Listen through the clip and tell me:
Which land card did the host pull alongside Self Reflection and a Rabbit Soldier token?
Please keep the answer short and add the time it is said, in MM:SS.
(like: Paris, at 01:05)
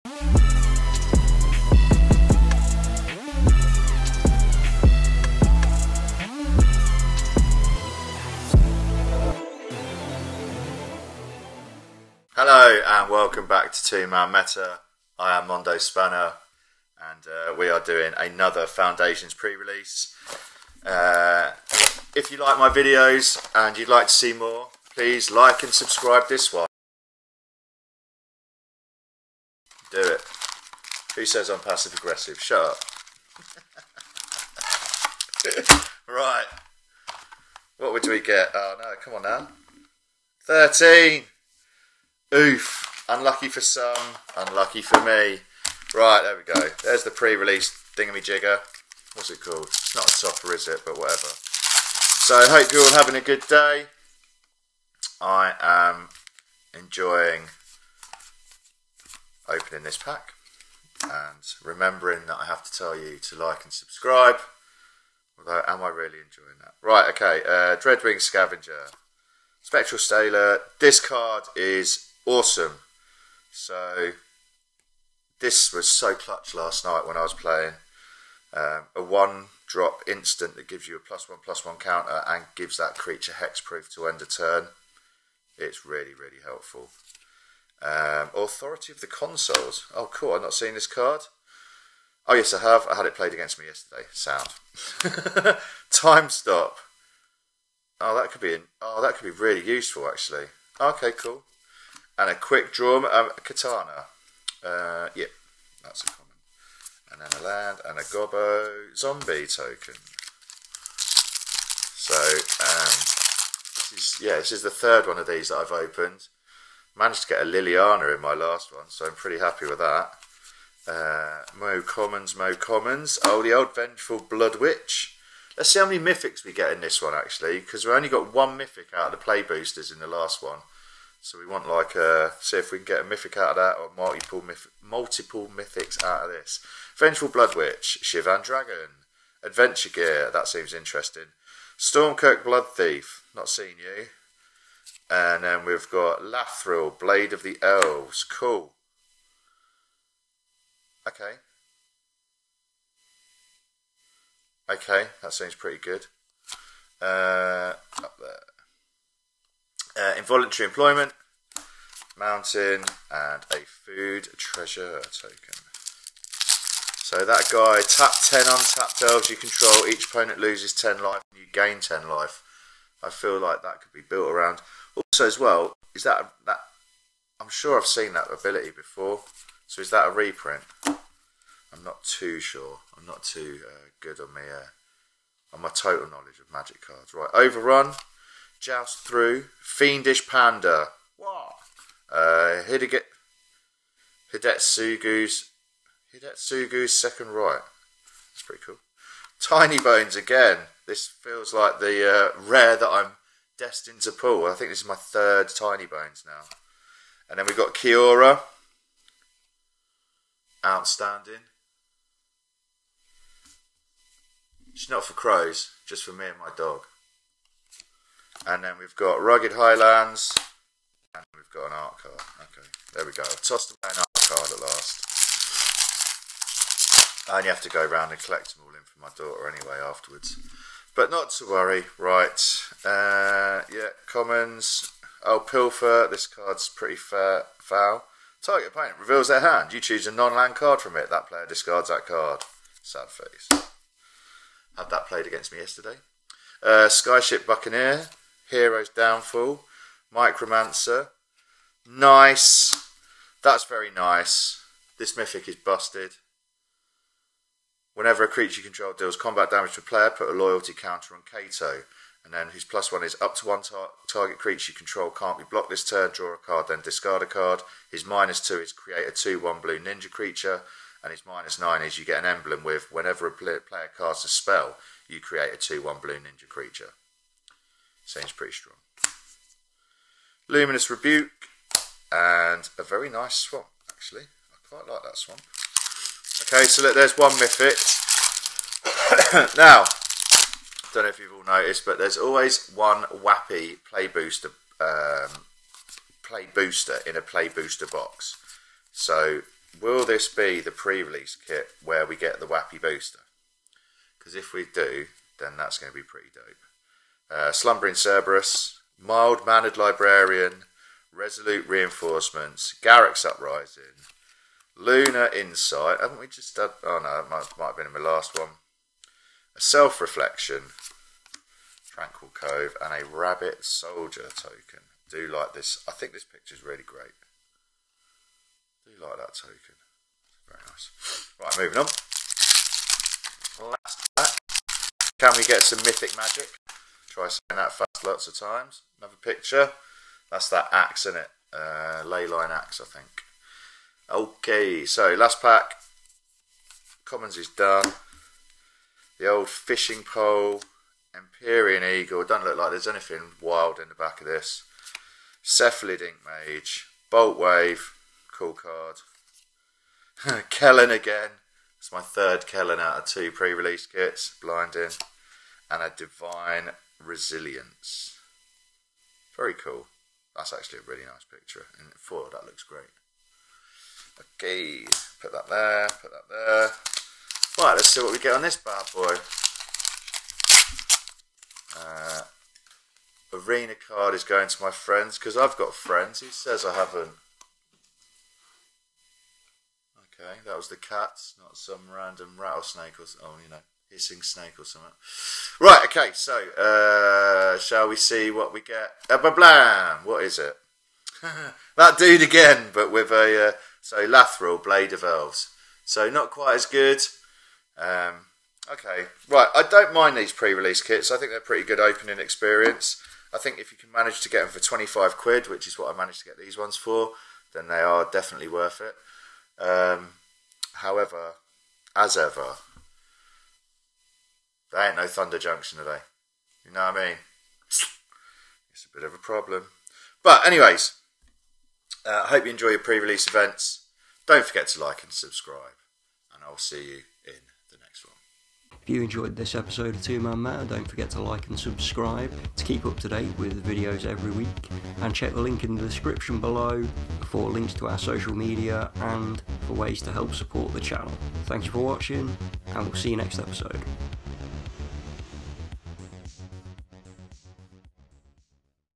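Tranquil Cove, at 05:21.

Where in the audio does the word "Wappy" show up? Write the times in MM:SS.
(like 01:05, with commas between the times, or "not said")
04:53, 05:02.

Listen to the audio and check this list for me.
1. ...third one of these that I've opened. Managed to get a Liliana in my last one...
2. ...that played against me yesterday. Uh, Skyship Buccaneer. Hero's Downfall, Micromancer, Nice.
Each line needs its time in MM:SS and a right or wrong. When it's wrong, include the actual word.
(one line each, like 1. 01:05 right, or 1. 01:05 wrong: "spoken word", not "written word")
1. 01:54 right
2. 04:04 right.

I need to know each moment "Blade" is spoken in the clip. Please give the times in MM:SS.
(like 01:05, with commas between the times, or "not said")
02:26, 06:44.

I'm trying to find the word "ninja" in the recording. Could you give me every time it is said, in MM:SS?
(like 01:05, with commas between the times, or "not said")
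04:29, 04:36.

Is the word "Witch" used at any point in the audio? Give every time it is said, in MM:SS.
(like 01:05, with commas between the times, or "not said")
02:04, 02:17.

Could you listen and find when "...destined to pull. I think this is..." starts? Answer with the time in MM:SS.
03:23.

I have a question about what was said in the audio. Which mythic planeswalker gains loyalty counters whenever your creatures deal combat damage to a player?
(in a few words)
Kaito.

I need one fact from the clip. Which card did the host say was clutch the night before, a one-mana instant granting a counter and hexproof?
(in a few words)
Spectral Sailor.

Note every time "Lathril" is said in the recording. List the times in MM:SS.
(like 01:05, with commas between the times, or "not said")
02:26, 06:44.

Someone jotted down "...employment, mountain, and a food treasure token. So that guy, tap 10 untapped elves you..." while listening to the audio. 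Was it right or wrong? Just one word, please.
right.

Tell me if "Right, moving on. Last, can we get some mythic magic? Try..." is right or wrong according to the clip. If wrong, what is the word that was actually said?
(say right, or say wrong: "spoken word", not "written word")
right.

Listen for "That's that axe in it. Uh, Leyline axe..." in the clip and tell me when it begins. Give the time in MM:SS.
05:40.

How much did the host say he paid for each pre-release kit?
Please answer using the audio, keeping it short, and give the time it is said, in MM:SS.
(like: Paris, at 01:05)
25 quid, at 06:54.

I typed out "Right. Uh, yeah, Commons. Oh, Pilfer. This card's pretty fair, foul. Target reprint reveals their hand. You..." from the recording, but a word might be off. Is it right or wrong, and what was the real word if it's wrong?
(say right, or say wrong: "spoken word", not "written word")
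wrong: "opponent", not "reprint".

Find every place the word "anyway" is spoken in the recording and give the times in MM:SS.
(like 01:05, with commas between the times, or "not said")
03:49, 07:10.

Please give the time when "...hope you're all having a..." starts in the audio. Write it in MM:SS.
00:52.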